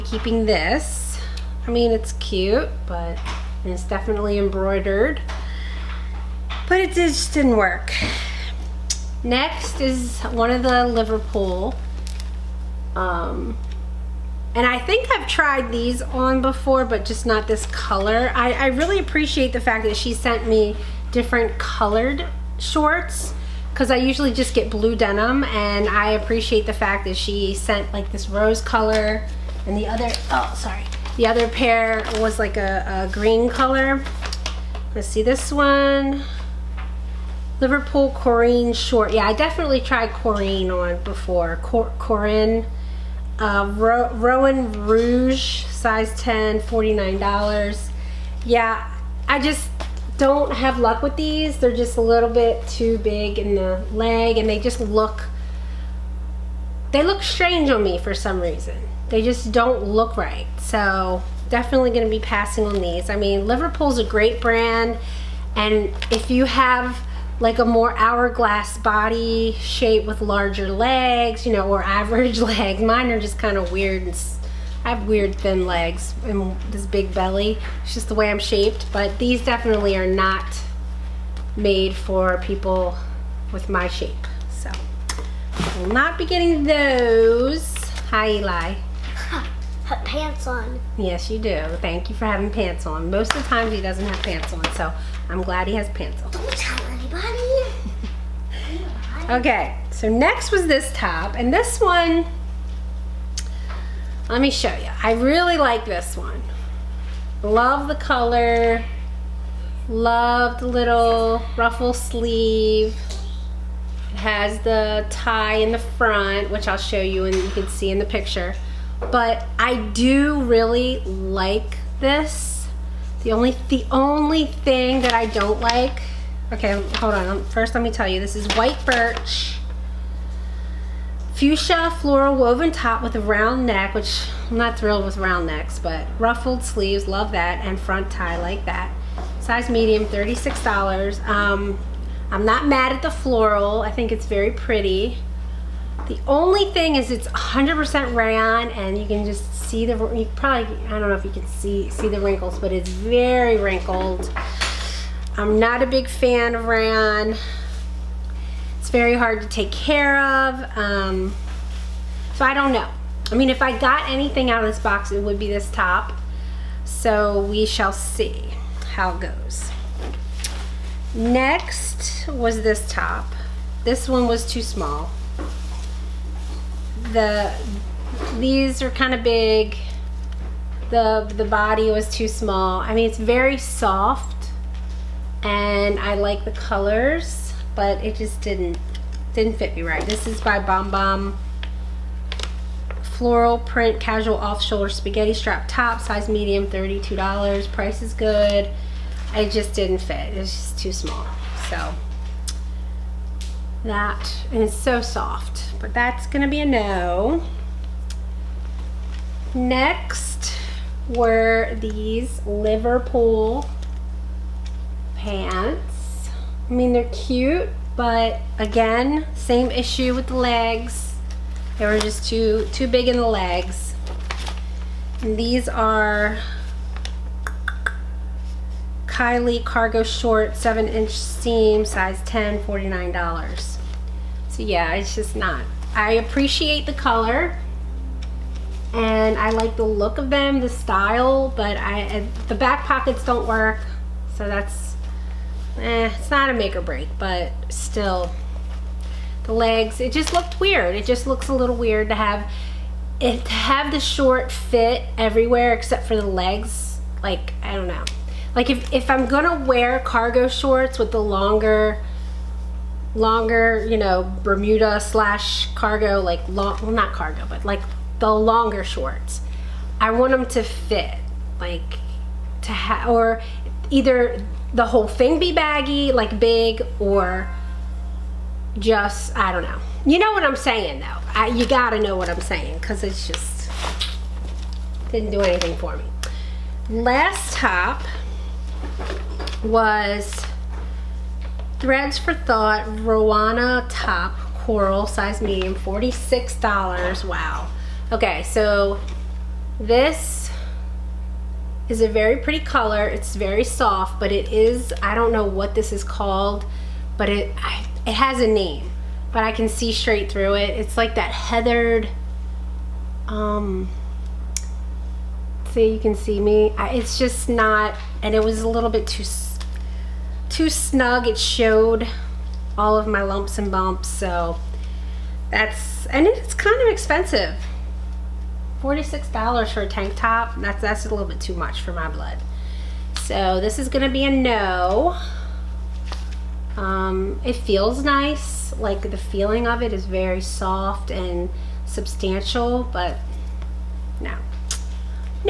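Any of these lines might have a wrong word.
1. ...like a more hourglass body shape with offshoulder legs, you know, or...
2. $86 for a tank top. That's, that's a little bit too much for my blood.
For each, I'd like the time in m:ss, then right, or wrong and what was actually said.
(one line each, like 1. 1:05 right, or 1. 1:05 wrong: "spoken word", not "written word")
1. 1:07 wrong: "larger", not "offshoulder"
2. 5:28 wrong: "46", not "86".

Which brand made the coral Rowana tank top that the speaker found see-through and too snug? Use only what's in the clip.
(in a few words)
Threads for Thought.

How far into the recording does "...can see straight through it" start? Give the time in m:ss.
5:09.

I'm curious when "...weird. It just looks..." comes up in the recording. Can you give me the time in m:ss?
4:10.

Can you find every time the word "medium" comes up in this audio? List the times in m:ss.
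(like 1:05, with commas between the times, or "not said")
2:19, 3:16, 4:55.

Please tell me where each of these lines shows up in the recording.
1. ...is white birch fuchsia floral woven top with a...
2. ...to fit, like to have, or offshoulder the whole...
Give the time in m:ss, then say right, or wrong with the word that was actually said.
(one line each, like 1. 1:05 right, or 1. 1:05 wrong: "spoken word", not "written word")
1. 2:08 right
2. 4:30 wrong: "either", not "offshoulder".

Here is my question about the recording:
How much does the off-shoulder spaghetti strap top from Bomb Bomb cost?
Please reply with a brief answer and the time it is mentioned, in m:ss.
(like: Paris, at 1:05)
$32, at 3:16.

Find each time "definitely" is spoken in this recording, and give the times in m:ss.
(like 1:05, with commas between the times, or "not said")
0:03, 0:39, 1:01, 1:19.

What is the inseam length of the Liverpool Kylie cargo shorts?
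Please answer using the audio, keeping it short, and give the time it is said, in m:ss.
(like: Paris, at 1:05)
7 inch, at 3:50.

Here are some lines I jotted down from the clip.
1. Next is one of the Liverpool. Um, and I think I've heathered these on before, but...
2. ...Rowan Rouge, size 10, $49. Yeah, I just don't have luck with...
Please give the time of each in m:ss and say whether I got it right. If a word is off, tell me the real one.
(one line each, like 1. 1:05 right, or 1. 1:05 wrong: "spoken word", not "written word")
1. 0:09 wrong: "tried", not "heathered"
2. 0:44 right.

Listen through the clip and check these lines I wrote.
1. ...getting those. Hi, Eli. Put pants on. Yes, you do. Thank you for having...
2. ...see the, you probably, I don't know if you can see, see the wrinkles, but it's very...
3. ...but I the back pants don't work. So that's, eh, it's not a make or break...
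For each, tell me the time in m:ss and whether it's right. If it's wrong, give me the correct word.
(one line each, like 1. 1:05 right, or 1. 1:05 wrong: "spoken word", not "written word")
1. 1:26 right
2. 2:29 right
3. 4:01 wrong: "pockets", not "pants".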